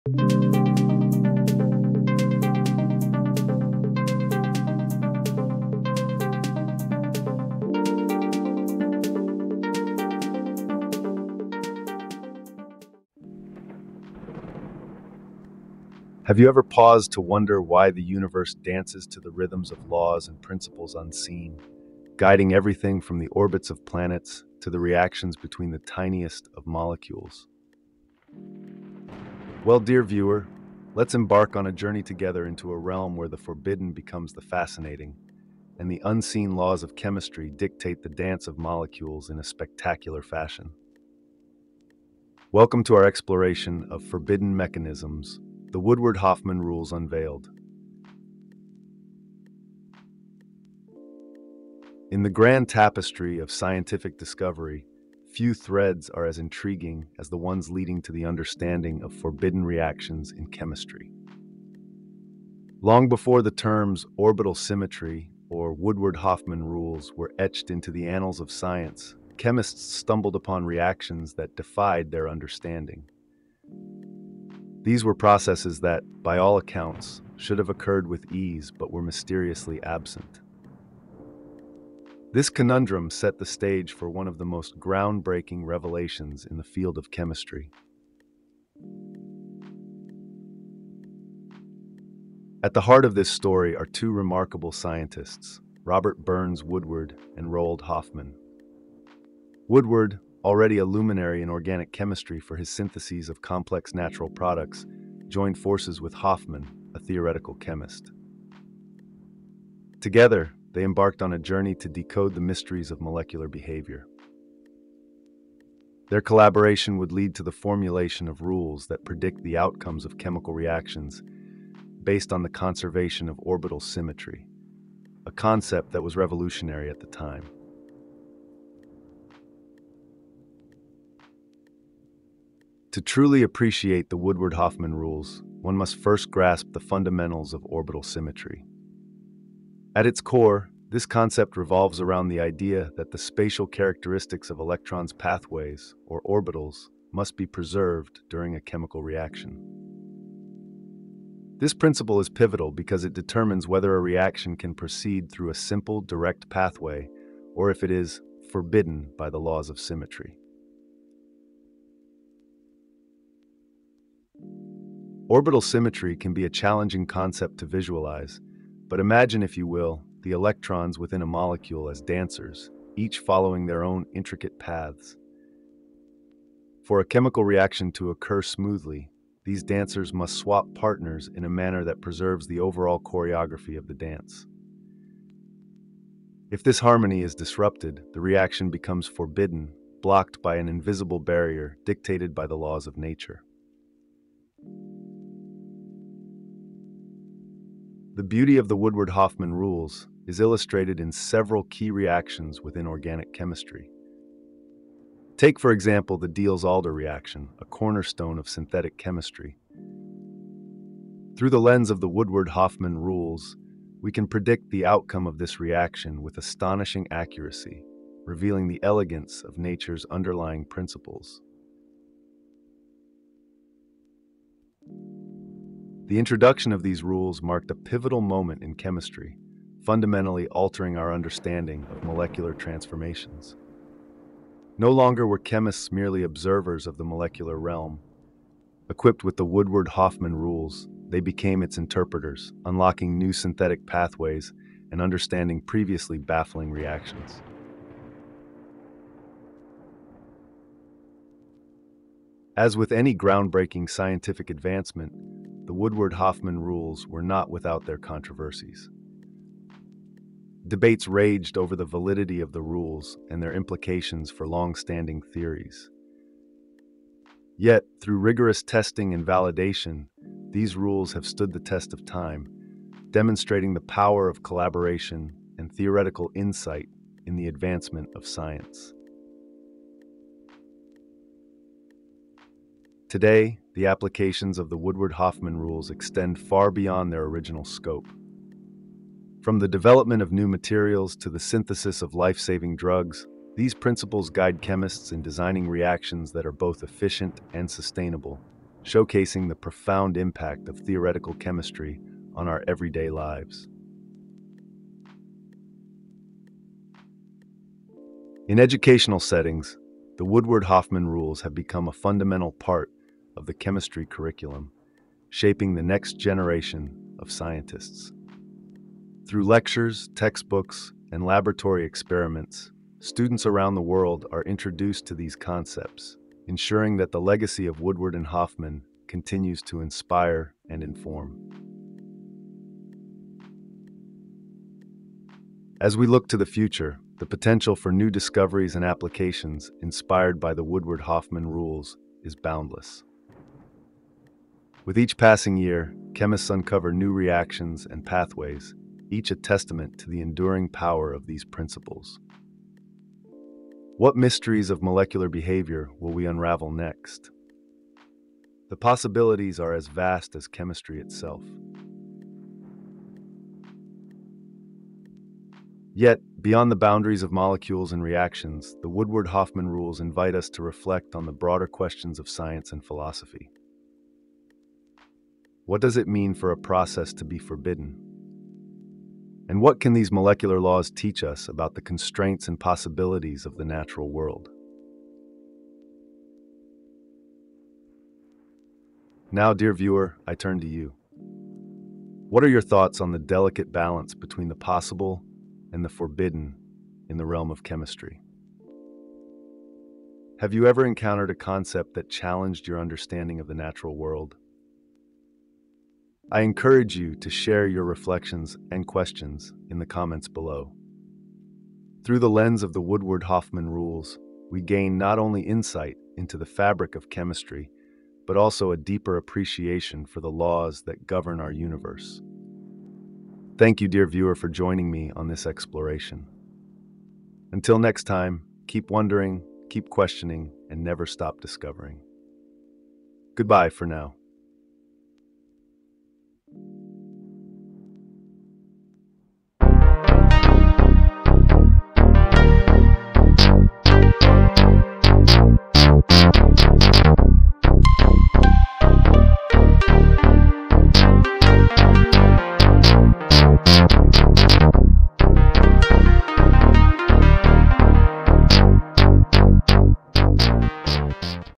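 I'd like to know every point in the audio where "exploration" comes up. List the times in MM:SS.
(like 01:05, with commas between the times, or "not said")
00:43, 07:05.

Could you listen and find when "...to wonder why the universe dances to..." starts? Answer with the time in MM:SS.
00:17.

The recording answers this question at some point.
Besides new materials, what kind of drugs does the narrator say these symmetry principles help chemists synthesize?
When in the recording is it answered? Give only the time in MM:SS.
04:52.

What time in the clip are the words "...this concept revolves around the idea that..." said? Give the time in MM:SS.
02:20.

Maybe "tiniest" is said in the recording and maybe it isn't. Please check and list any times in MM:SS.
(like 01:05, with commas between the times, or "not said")
00:25.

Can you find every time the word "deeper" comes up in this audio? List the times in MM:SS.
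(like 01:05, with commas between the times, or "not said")
06:58.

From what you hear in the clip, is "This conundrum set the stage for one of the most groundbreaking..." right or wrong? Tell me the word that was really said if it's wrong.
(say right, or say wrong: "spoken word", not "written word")
right.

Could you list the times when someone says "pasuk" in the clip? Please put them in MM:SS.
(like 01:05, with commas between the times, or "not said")
not said.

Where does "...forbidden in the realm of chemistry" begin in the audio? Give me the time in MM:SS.
06:35.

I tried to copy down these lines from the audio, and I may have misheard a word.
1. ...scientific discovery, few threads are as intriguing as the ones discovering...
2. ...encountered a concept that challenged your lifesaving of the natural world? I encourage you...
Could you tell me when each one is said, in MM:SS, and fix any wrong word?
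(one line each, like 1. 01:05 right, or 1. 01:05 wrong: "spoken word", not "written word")
1. 00:53 wrong: "leading", not "discovering"
2. 06:40 wrong: "understanding", not "lifesaving".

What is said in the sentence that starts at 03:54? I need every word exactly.
No longer were chemists merely observers of the molecular realm.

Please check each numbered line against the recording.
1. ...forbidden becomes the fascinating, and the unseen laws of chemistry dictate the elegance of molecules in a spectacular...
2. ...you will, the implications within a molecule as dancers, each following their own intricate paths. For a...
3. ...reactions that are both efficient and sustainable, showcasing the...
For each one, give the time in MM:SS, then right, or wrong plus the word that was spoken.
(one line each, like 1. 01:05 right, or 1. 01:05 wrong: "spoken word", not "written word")
1. 00:33 wrong: "dance", not "elegance"
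2. 02:49 wrong: "electrons", not "implications"
3. 04:55 right.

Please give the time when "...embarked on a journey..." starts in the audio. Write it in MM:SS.
01:50.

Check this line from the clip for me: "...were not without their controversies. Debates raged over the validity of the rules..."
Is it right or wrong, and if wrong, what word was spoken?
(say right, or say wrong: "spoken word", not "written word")
right.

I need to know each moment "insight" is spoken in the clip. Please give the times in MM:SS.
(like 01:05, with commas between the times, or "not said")
04:36, 06:55.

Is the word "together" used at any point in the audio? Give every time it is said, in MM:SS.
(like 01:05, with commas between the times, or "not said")
00:32, 01:49.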